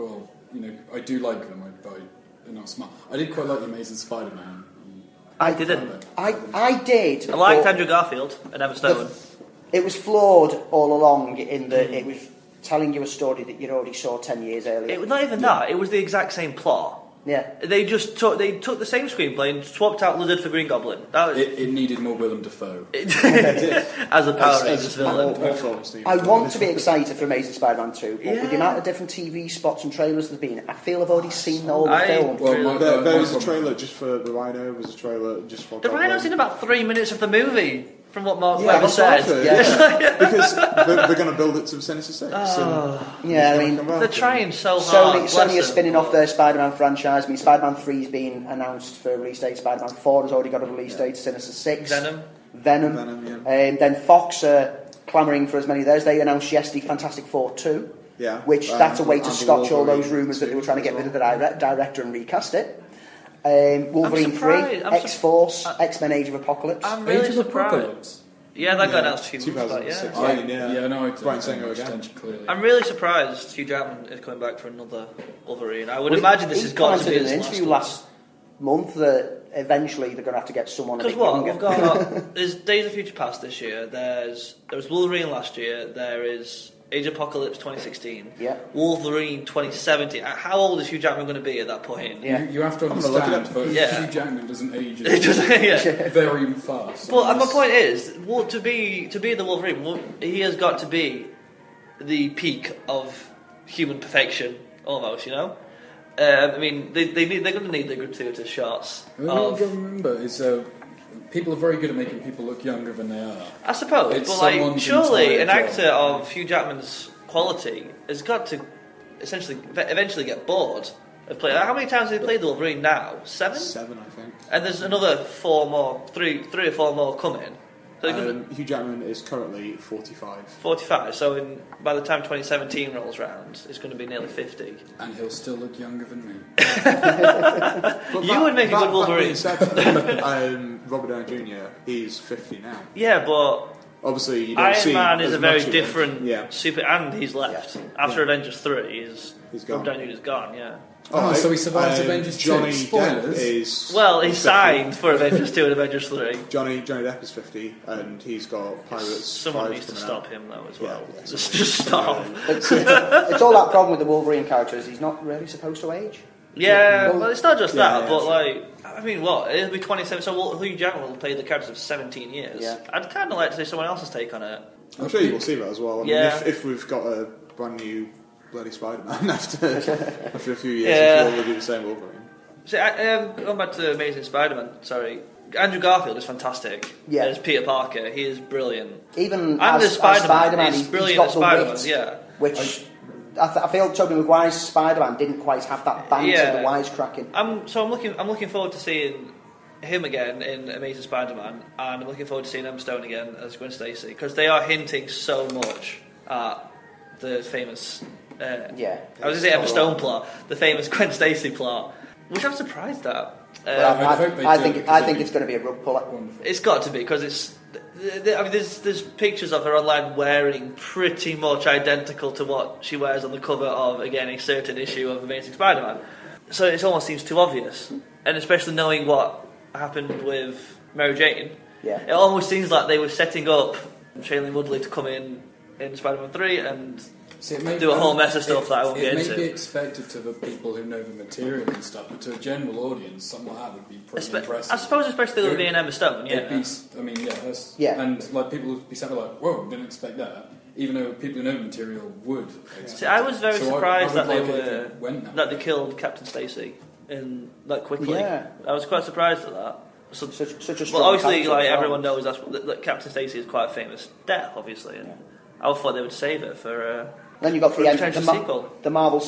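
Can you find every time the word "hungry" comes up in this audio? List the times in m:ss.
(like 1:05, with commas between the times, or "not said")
not said.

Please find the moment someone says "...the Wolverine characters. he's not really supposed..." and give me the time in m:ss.
2:44.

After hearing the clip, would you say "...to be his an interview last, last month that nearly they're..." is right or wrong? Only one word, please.
wrong.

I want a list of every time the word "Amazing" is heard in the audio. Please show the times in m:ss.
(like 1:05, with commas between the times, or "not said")
0:03, 0:27, 3:03, 3:20, 3:45.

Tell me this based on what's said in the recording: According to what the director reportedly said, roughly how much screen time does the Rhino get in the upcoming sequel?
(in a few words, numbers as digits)
about 3 minutes.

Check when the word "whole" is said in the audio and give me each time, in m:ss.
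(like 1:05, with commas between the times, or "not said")
0:31, 3:57.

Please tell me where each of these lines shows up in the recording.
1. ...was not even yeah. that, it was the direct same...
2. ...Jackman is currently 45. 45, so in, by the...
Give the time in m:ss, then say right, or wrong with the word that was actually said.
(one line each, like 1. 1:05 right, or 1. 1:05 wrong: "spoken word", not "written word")
1. 0:15 wrong: "exact", not "direct"
2. 2:08 right.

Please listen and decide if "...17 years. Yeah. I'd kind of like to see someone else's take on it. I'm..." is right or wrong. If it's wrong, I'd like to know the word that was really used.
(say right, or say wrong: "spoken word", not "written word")
right.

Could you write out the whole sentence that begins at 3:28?
Uh, yeah, I was going to say Emma Stone plot, the famous Gwen Stacy plot, which I'm surprised at.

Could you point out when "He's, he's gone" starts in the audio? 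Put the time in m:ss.
2:29.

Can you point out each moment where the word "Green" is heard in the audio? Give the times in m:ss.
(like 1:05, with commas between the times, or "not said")
0:20.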